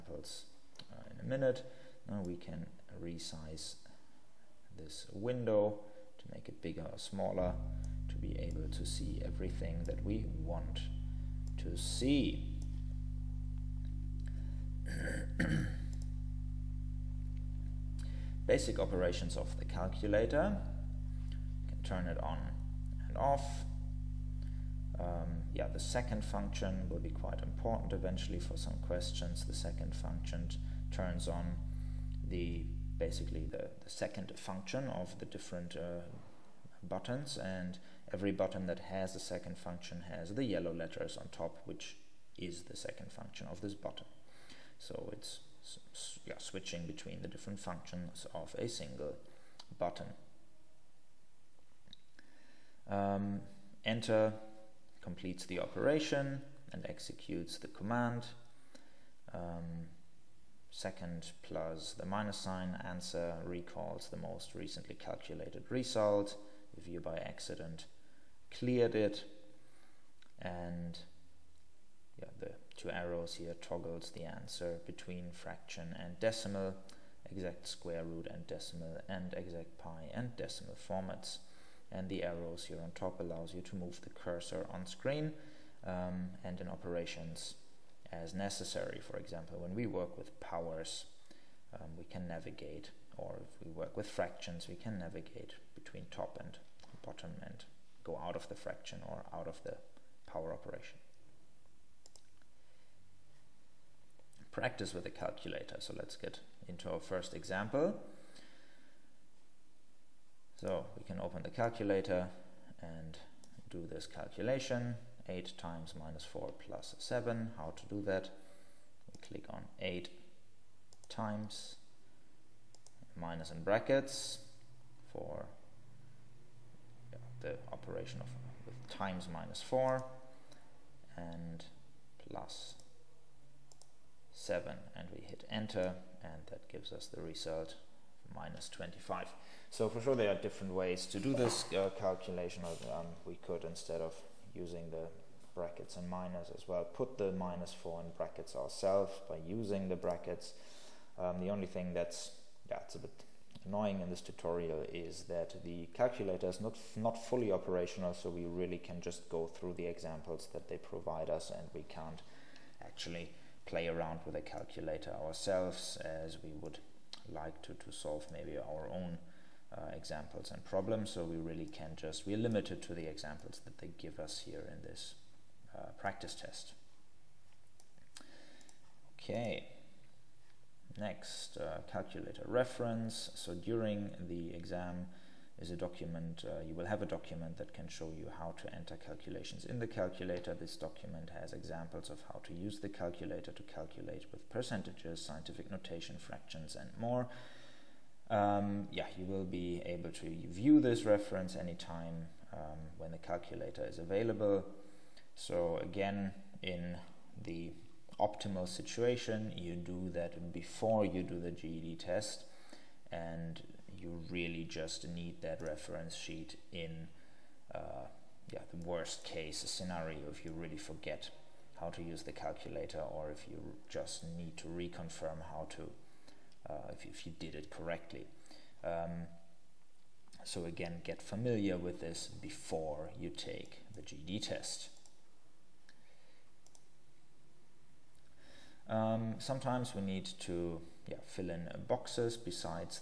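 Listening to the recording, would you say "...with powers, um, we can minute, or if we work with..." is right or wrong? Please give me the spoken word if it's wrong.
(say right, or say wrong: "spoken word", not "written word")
wrong: "navigate", not "minute".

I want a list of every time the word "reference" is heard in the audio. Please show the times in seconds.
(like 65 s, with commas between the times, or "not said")
182 s, 201 s, 215 s.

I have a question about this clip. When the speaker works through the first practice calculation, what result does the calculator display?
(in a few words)
-25.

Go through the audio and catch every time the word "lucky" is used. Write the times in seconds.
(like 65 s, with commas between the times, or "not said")
not said.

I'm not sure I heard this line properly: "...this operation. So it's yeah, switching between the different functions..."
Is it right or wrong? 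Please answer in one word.
wrong.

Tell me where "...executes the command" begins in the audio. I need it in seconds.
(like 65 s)
56 s.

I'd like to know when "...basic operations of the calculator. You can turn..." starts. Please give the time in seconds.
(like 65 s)
18 s.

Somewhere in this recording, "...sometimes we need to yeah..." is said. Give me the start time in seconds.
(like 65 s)
239 s.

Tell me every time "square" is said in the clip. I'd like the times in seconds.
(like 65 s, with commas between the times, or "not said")
77 s.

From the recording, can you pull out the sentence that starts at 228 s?
Um, so again, get familiar with this before you take the GED test.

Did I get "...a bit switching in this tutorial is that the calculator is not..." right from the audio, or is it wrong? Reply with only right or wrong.
wrong.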